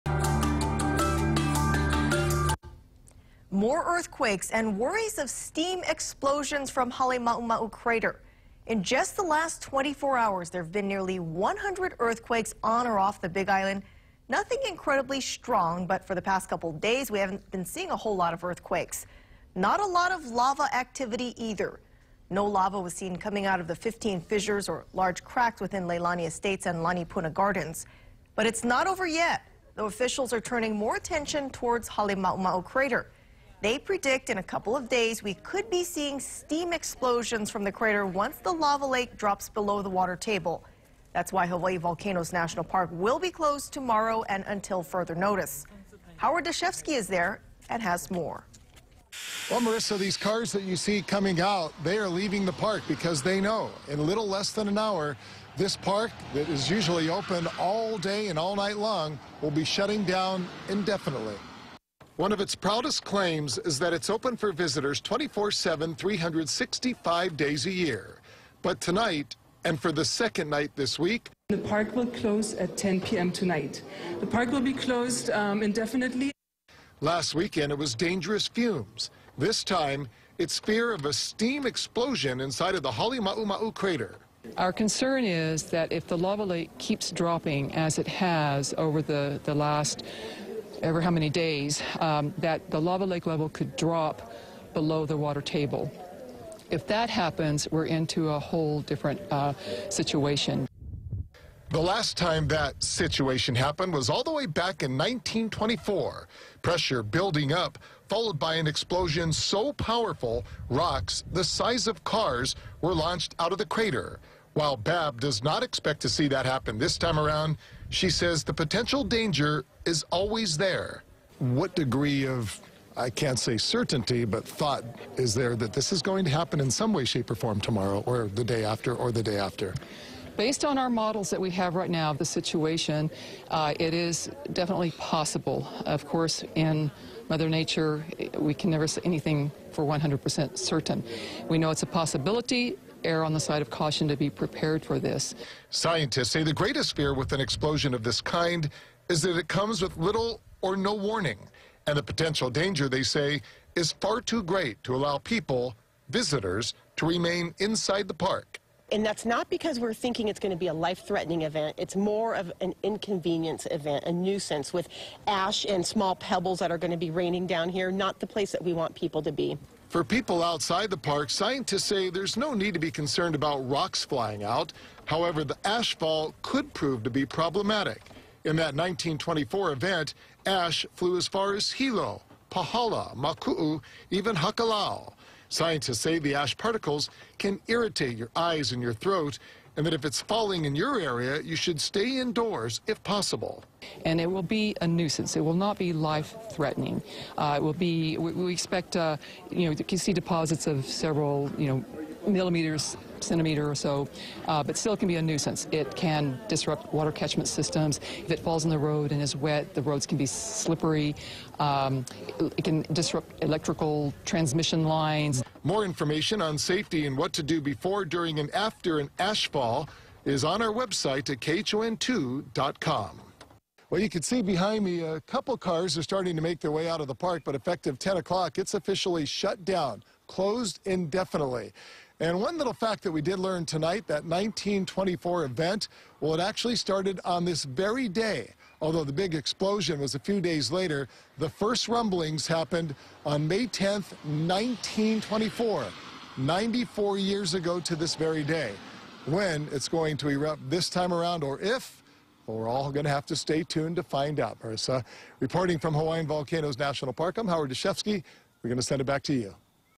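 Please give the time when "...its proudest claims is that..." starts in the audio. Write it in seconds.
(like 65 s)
62 s.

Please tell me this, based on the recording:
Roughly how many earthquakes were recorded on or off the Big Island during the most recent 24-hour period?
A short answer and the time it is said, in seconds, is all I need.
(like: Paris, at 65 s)
nearly 100, at 10 s.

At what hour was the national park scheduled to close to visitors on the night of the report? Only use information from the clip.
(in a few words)
10 p.m.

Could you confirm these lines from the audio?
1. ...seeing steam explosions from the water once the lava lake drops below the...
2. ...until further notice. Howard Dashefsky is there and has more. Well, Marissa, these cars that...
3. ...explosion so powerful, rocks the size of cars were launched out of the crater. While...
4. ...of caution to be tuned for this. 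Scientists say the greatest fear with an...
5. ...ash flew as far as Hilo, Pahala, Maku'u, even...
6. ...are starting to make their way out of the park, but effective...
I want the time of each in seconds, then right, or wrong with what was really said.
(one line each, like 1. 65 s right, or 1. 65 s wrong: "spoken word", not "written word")
1. 35 s wrong: "crater", not "water"
2. 44 s right
3. 108 s right
4. 143 s wrong: "prepared", not "tuned"
5. 180 s right
6. 225 s right.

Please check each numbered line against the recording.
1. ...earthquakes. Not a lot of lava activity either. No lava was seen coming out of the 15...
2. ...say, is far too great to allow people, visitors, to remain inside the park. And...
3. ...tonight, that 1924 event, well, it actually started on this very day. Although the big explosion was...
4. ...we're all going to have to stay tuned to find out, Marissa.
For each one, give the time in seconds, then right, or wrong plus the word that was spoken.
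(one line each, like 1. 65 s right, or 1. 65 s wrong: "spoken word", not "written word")
1. 18 s right
2. 153 s right
3. 233 s right
4. 252 s right.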